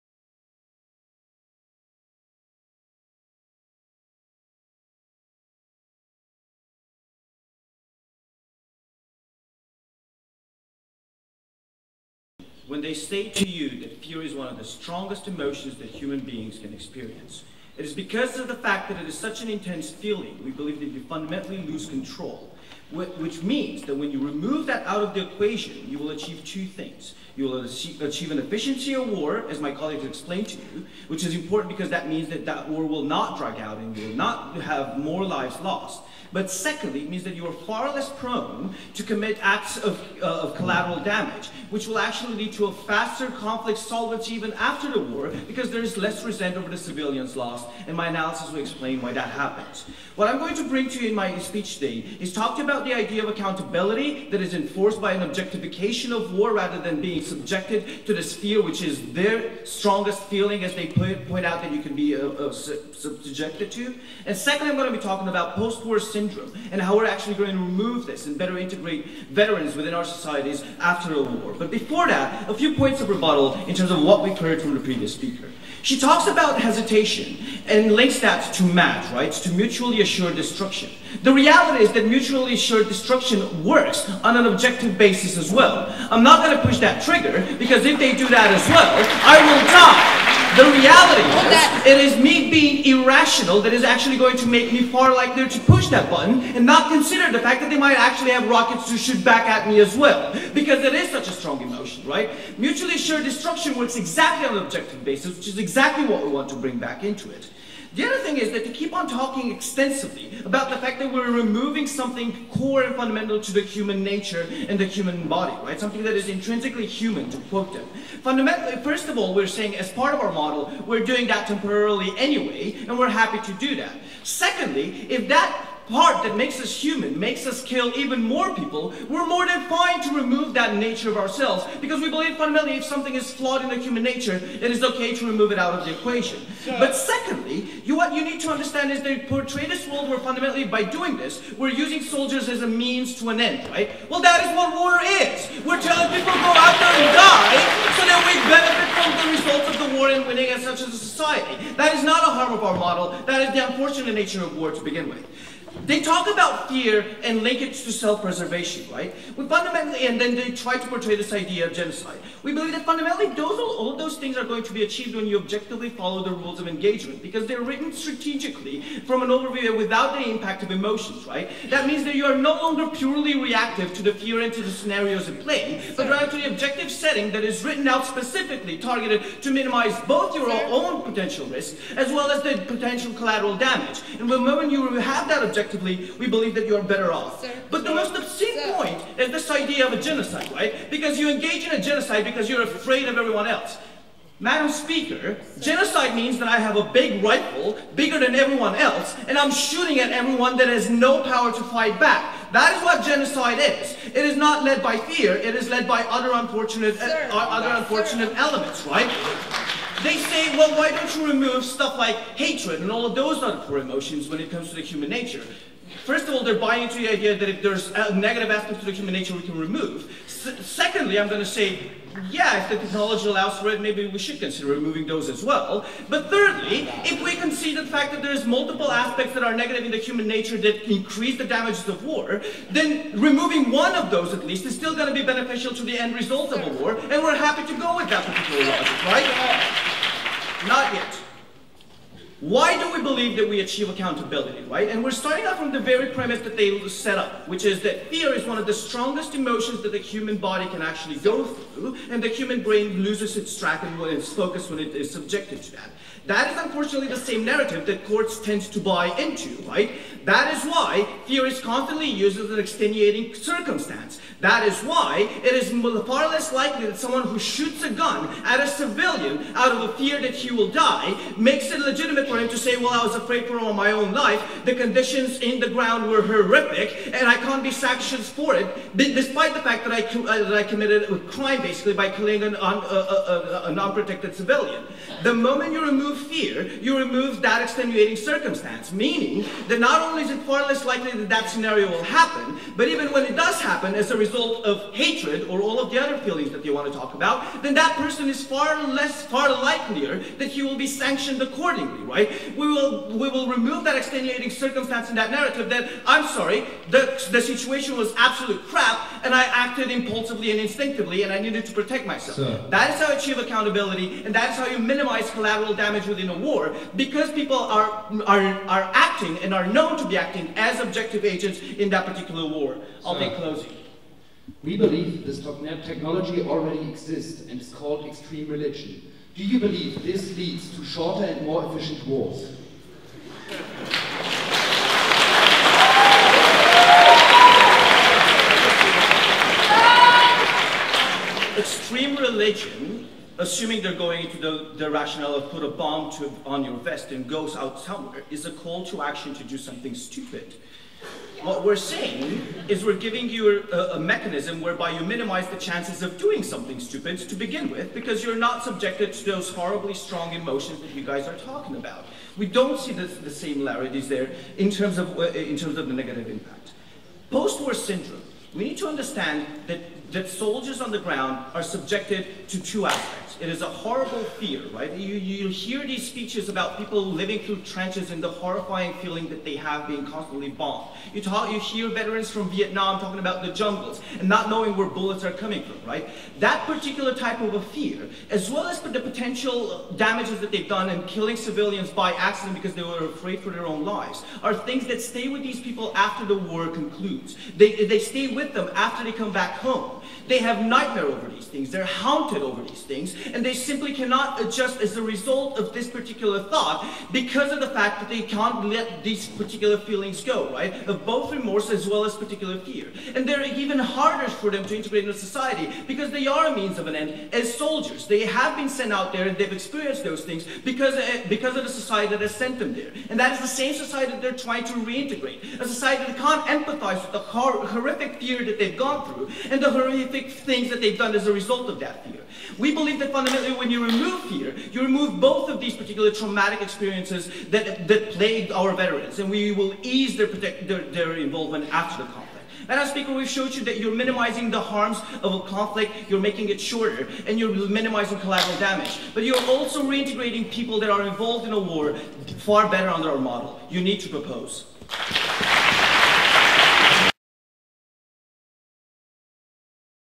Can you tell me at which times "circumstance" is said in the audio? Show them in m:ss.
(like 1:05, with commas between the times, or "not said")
4:23, 4:48, 5:04.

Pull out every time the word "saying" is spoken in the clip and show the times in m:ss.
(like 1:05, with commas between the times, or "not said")
1:59, 5:51.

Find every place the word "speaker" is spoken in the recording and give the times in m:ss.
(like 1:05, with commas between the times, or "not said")
1:15, 3:14, 7:22.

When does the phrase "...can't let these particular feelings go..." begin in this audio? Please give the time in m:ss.
6:48.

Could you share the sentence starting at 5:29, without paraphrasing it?
Do you believe this leads to shorter and more efficient wars?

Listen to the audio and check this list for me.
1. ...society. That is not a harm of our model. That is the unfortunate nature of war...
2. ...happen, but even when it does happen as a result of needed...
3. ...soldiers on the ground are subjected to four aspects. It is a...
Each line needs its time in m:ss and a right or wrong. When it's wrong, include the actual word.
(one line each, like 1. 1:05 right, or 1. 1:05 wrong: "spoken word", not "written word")
1. 2:30 right
2. 4:52 wrong: "hatred", not "needed"
3. 6:10 wrong: "two", not "four".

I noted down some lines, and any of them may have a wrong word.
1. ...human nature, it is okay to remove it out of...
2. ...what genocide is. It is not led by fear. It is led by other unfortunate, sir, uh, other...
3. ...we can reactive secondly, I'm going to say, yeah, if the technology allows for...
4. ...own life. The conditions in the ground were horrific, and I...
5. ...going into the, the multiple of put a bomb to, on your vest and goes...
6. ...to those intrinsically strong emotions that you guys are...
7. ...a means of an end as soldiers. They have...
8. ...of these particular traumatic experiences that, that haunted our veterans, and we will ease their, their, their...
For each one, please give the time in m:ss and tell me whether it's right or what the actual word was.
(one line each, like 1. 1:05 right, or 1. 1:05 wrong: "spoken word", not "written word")
1. 2:13 right
2. 3:22 right
3. 3:39 wrong: "remove", not "reactive"
4. 4:33 right
5. 5:44 wrong: "rationale", not "multiple"
6. 5:59 wrong: "horribly", not "intrinsically"
7. 6:56 right
8. 7:15 wrong: "plagued", not "haunted".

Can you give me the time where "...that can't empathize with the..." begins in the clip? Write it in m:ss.
7:06.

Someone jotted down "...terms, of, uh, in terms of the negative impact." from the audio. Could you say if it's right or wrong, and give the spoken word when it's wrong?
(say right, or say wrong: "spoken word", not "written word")
right.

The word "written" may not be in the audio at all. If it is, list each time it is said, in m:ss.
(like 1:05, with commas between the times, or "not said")
2:47, 2:57.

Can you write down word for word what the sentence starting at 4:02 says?
Why do we believe that we achieve accountability, right?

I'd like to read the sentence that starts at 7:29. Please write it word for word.
But you're also reintegrating people that are involved in a war far better under our model.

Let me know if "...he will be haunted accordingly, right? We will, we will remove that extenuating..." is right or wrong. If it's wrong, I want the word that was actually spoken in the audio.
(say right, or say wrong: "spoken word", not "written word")
wrong: "sanctioned", not "haunted".